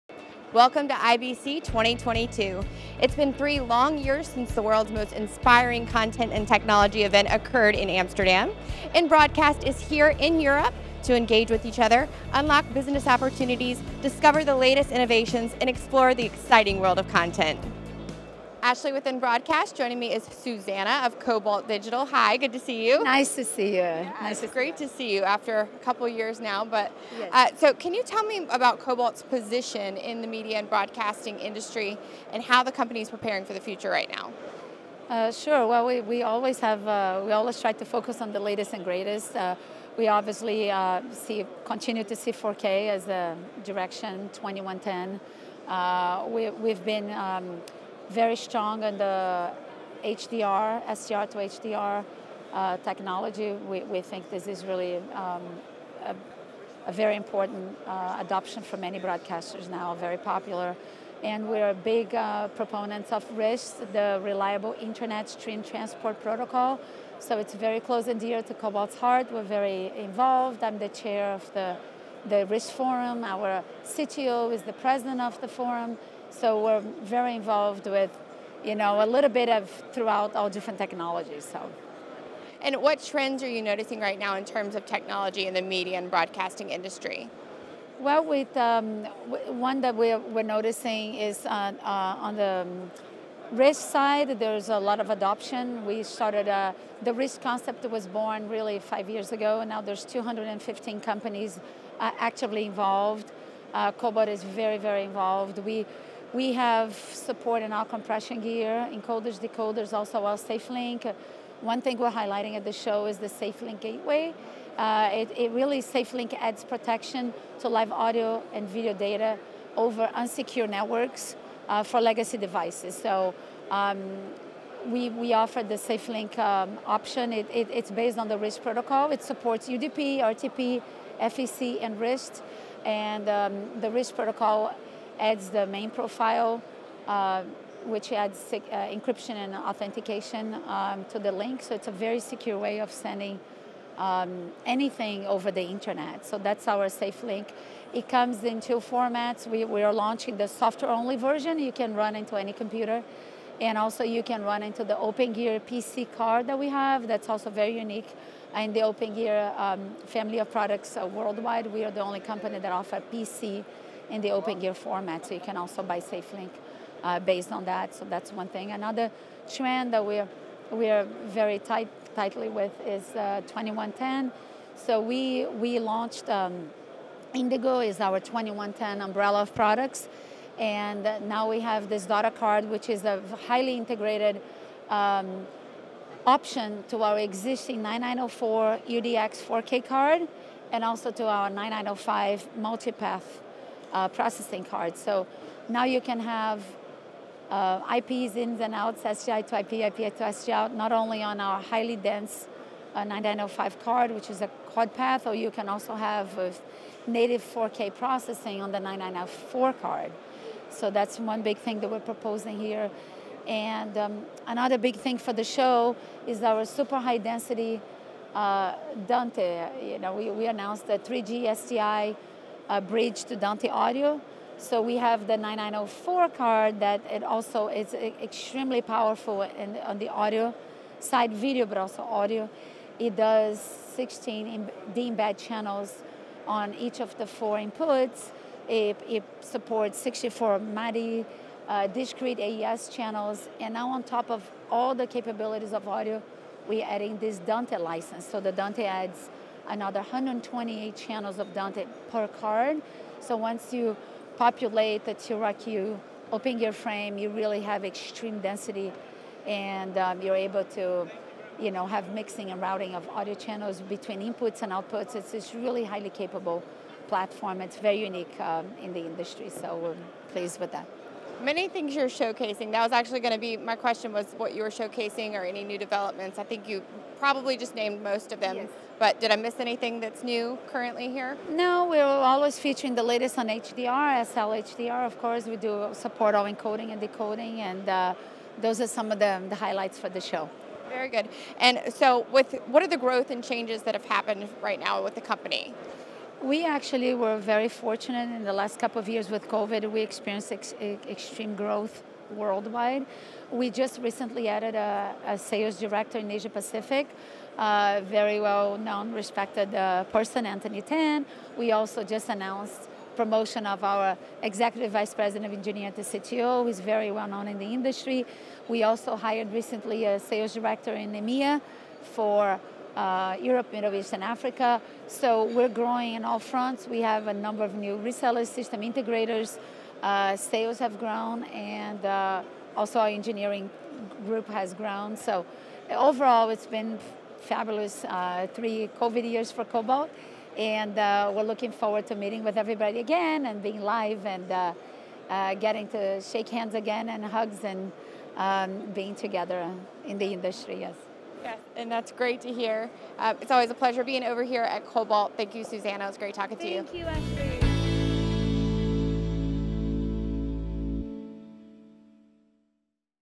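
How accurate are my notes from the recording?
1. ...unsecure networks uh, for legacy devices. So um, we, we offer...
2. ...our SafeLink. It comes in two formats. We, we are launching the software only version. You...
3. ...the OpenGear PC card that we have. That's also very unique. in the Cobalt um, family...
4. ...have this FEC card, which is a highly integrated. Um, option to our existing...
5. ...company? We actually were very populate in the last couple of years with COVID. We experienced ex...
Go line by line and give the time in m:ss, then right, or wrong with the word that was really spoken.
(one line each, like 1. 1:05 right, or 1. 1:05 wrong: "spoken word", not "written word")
1. 2:00 right
2. 2:26 right
3. 2:34 wrong: "OpenGear", not "Cobalt"
4. 3:01 wrong: "Data", not "FEC"
5. 4:55 wrong: "fortunate", not "populate".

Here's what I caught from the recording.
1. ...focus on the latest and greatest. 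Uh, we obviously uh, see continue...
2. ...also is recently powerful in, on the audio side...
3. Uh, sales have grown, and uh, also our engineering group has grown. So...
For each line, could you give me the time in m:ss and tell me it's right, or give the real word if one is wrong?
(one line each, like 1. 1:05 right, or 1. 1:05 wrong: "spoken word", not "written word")
1. 0:37 right
2. 3:47 wrong: "extremely", not "recently"
3. 5:30 right.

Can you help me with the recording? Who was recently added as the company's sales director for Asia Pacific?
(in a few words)
Anthony Tan.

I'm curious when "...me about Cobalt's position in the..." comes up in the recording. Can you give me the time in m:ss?
0:28.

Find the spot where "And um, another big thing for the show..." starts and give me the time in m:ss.
3:33.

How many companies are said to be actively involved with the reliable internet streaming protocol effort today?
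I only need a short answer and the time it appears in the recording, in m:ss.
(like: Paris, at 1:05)
215, at 1:40.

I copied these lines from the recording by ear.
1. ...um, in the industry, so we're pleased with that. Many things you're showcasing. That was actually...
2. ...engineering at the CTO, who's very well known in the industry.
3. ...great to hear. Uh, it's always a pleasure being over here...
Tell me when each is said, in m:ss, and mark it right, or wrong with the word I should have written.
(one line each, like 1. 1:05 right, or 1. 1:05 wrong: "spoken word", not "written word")
1. 4:28 right
2. 5:15 right
3. 5:52 right.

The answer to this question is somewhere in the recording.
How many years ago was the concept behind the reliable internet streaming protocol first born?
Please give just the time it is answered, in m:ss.
1:38.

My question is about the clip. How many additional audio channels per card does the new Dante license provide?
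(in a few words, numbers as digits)
128.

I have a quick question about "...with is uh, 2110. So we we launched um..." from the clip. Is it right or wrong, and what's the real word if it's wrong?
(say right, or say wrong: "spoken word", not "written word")
right.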